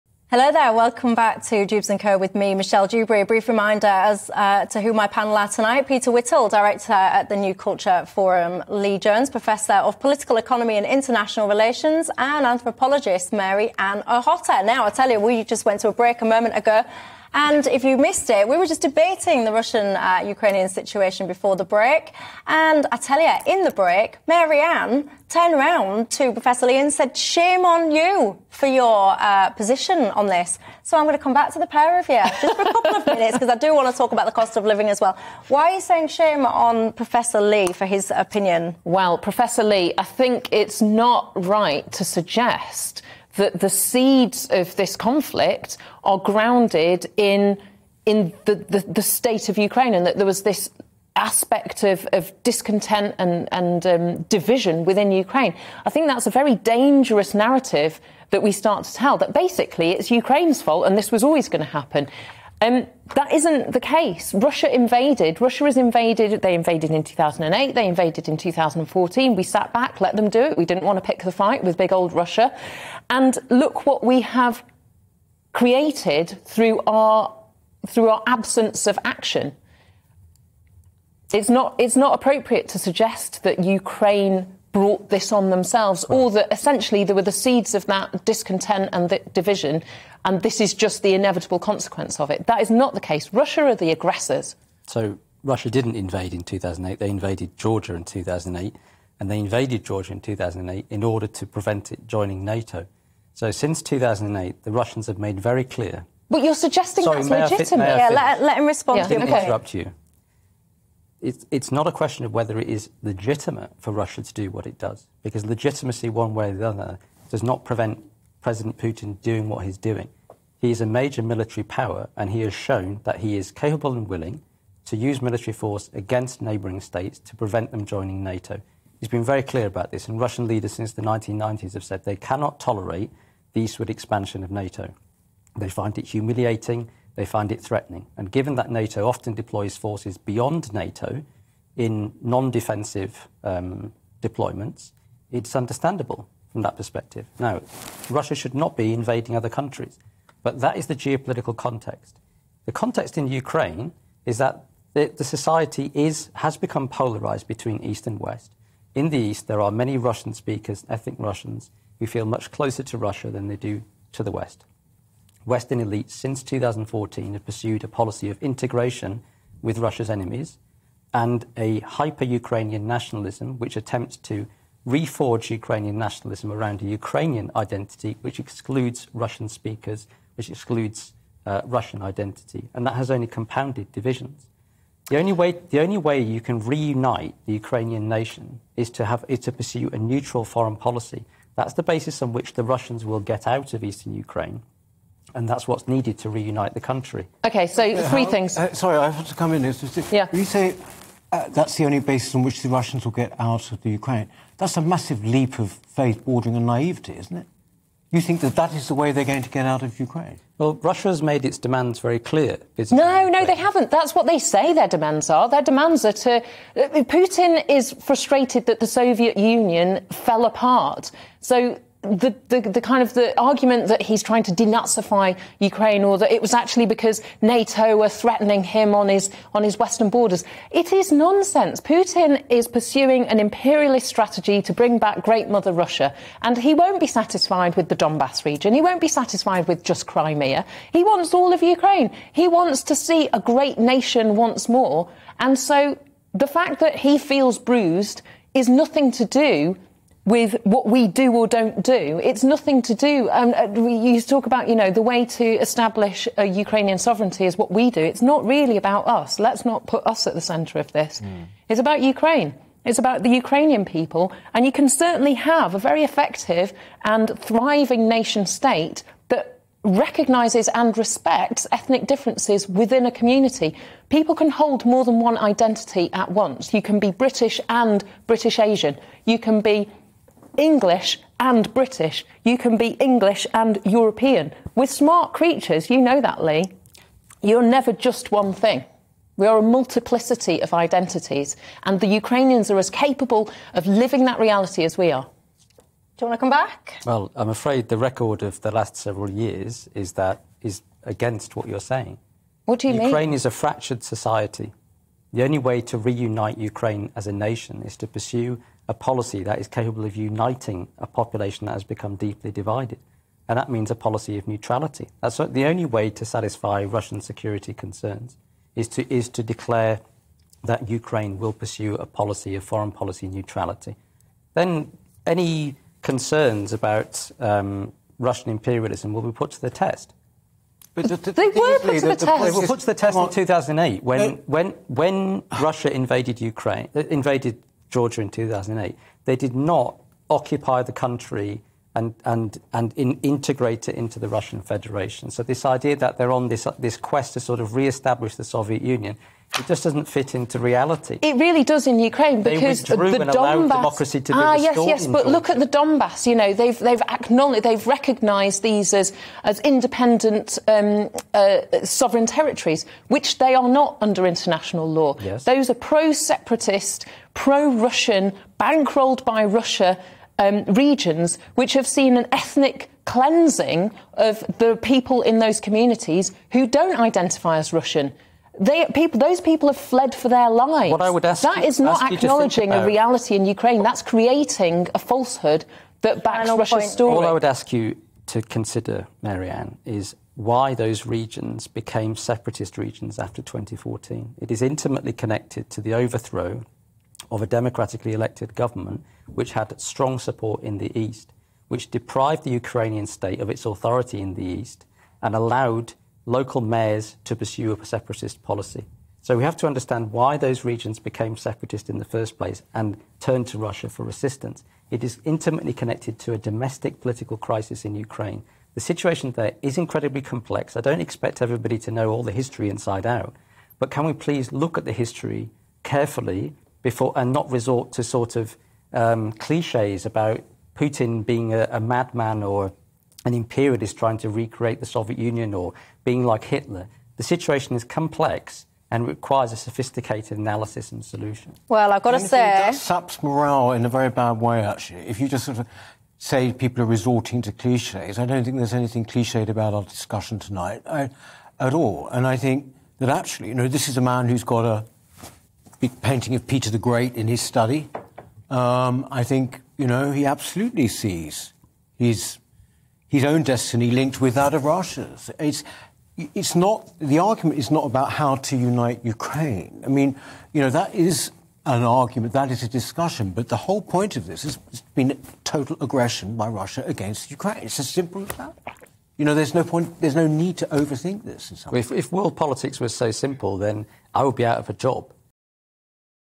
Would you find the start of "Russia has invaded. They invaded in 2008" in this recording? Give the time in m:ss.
1:05.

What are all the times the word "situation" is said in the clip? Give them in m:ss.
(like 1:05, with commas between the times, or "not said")
0:20, 6:58, 7:17.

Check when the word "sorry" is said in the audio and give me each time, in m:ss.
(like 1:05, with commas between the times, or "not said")
1:47, 3:18.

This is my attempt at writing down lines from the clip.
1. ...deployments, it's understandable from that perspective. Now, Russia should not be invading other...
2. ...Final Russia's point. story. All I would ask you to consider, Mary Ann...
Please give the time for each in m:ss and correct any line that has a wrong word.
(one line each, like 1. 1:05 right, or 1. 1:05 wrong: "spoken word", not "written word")
1. 2:24 right
2. 6:26 right.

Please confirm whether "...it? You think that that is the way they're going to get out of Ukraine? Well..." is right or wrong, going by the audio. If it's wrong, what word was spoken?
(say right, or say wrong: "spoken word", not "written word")
right.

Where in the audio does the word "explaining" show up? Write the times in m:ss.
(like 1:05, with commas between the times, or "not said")
not said.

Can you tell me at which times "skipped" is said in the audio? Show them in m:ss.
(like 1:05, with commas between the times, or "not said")
not said.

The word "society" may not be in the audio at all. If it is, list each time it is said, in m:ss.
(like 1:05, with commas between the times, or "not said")
2:35, 5:04.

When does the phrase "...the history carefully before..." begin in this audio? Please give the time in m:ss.
7:04.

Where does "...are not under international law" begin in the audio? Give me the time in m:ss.
6:03.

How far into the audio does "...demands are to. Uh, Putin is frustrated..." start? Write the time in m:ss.
3:35.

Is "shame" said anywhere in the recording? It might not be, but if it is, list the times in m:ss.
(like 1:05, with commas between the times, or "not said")
0:27, 0:36.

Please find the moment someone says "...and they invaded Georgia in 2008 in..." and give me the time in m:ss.
1:39.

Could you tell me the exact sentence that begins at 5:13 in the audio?
And that means a policy of neutrality.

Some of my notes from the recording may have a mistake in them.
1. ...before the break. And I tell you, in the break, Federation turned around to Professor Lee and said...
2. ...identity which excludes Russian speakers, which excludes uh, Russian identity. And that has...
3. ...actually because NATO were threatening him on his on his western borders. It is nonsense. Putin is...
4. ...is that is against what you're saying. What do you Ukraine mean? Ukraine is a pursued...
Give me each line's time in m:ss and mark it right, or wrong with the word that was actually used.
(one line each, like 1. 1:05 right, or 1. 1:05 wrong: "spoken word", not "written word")
1. 0:21 wrong: "Ann", not "Federation"
2. 2:57 right
3. 3:46 right
4. 4:59 wrong: "fractured", not "pursued".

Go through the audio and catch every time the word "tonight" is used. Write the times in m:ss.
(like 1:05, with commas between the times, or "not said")
0:05, 7:30.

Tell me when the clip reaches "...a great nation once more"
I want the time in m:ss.
4:03.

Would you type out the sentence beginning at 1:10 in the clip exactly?
We didn't want to pick the fight with big old Russia.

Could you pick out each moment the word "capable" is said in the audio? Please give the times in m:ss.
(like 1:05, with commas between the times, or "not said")
2:03, 4:52, 5:09.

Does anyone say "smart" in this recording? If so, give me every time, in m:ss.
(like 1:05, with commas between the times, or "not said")
4:44.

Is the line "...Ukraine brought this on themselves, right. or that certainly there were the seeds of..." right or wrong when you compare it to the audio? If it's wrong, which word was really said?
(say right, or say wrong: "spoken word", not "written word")
wrong: "essentially", not "certainly".